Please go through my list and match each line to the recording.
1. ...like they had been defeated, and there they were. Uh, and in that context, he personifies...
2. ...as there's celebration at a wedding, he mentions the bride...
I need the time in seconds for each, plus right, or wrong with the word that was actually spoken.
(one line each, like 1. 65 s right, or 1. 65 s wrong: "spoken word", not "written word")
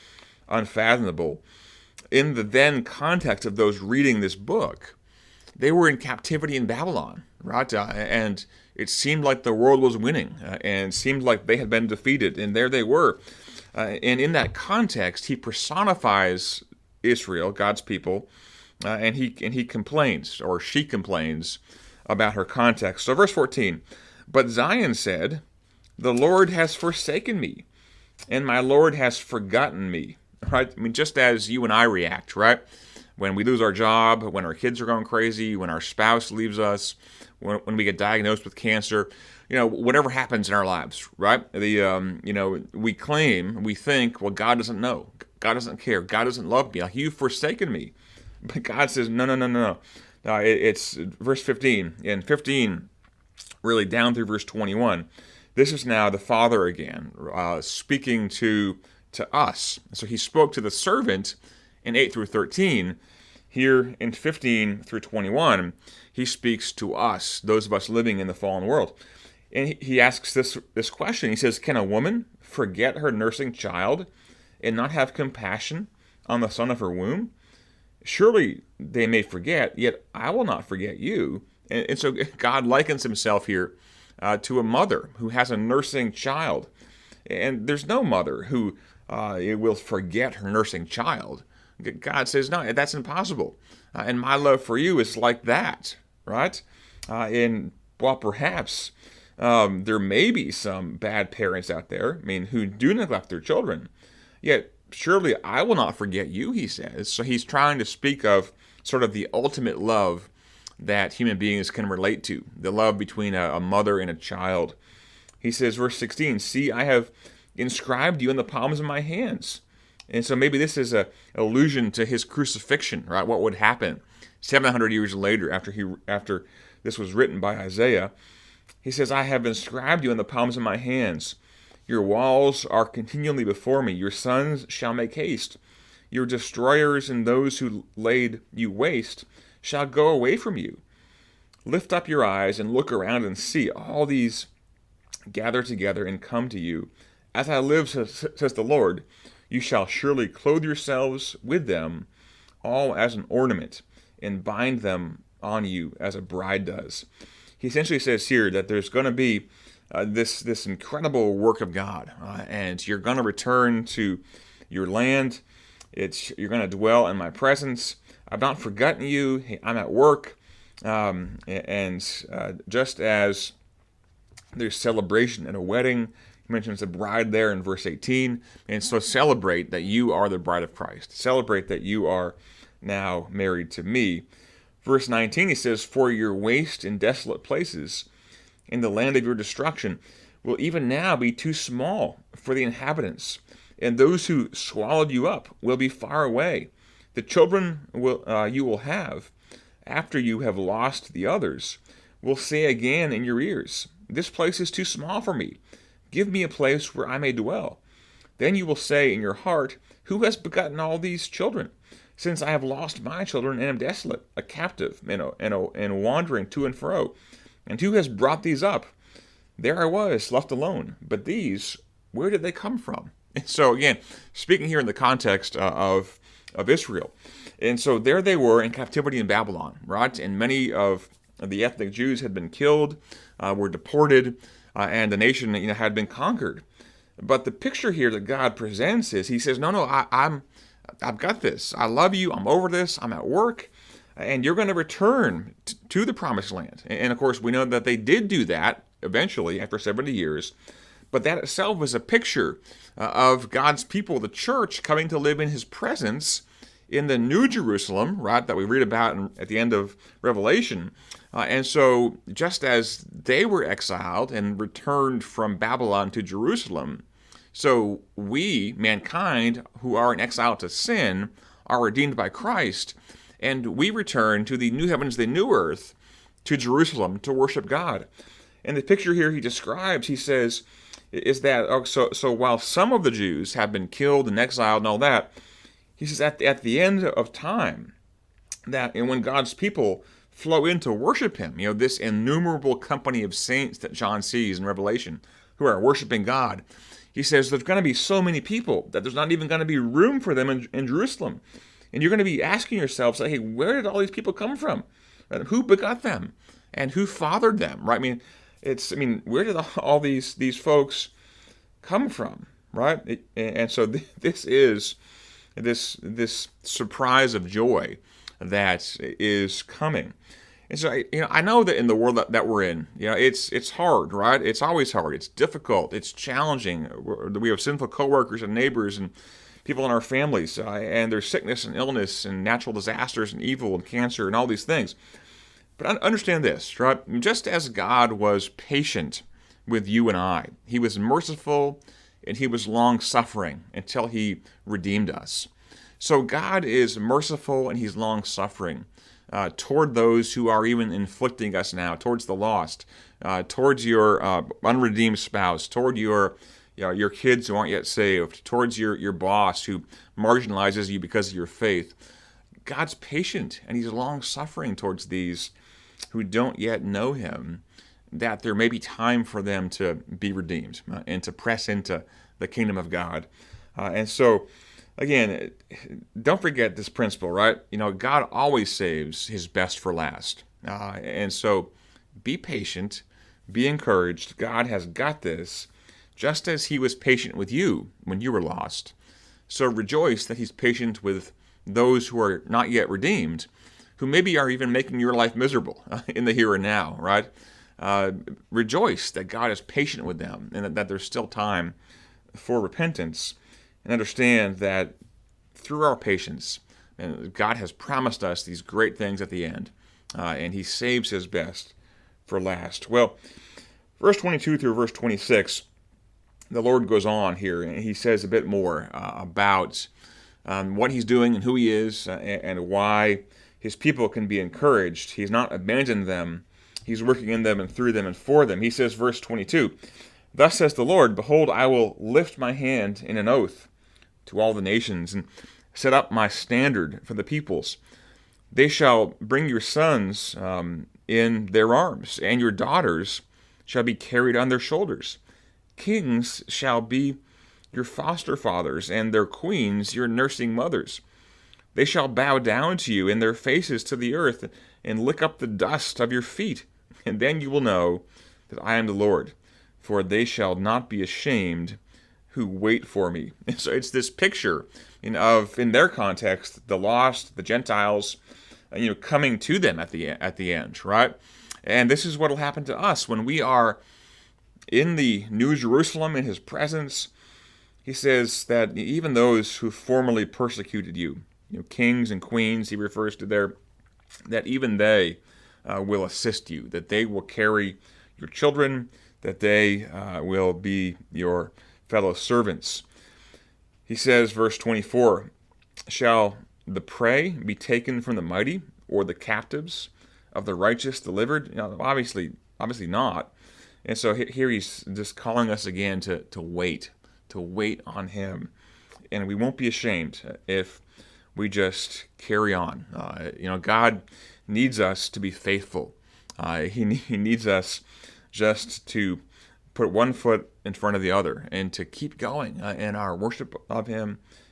1. 11 s right
2. 172 s right.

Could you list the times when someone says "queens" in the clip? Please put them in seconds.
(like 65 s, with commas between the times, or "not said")
449 s, 482 s.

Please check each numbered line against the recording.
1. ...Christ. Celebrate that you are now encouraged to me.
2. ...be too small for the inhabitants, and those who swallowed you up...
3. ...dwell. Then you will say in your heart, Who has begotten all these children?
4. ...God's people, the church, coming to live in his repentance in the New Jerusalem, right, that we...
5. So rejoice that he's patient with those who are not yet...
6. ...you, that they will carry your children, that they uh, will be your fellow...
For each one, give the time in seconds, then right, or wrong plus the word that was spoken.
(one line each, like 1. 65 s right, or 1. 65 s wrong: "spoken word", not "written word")
1. 180 s wrong: "married", not "encouraged"
2. 191 s right
3. 207 s right
4. 253 s wrong: "presence", not "repentance"
5. 389 s right
6. 486 s right.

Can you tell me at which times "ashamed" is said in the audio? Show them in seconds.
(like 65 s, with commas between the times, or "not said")
461 s, 509 s.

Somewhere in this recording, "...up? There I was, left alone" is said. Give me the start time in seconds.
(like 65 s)
218 s.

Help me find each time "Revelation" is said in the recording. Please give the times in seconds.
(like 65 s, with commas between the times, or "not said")
260 s, 294 s.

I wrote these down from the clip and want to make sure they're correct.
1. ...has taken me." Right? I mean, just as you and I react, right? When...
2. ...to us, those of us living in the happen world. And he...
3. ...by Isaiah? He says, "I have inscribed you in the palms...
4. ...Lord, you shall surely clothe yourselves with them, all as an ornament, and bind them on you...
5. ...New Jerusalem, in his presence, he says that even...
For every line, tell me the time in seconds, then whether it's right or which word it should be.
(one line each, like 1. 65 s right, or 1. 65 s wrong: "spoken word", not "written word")
1. 28 s wrong: "forgotten", not "taken"
2. 66 s wrong: "fallen", not "happen"
3. 127 s right
4. 148 s right
5. 475 s right.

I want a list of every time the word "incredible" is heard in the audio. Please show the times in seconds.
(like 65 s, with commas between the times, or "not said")
160 s.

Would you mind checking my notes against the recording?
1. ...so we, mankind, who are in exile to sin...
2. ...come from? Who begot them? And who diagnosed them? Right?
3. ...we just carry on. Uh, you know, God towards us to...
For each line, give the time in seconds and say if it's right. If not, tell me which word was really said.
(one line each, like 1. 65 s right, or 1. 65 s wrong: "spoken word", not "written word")
1. 267 s right
2. 304 s wrong: "fathered", not "diagnosed"
3. 511 s wrong: "needs", not "towards".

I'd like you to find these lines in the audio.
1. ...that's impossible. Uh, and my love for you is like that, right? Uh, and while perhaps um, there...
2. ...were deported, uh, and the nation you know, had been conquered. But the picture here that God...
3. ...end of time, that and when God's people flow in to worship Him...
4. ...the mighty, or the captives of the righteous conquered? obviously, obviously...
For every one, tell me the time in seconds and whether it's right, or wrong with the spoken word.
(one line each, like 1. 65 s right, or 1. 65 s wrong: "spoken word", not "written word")
1. 92 s right
2. 233 s right
3. 286 s right
4. 498 s wrong: "delivered", not "conquered".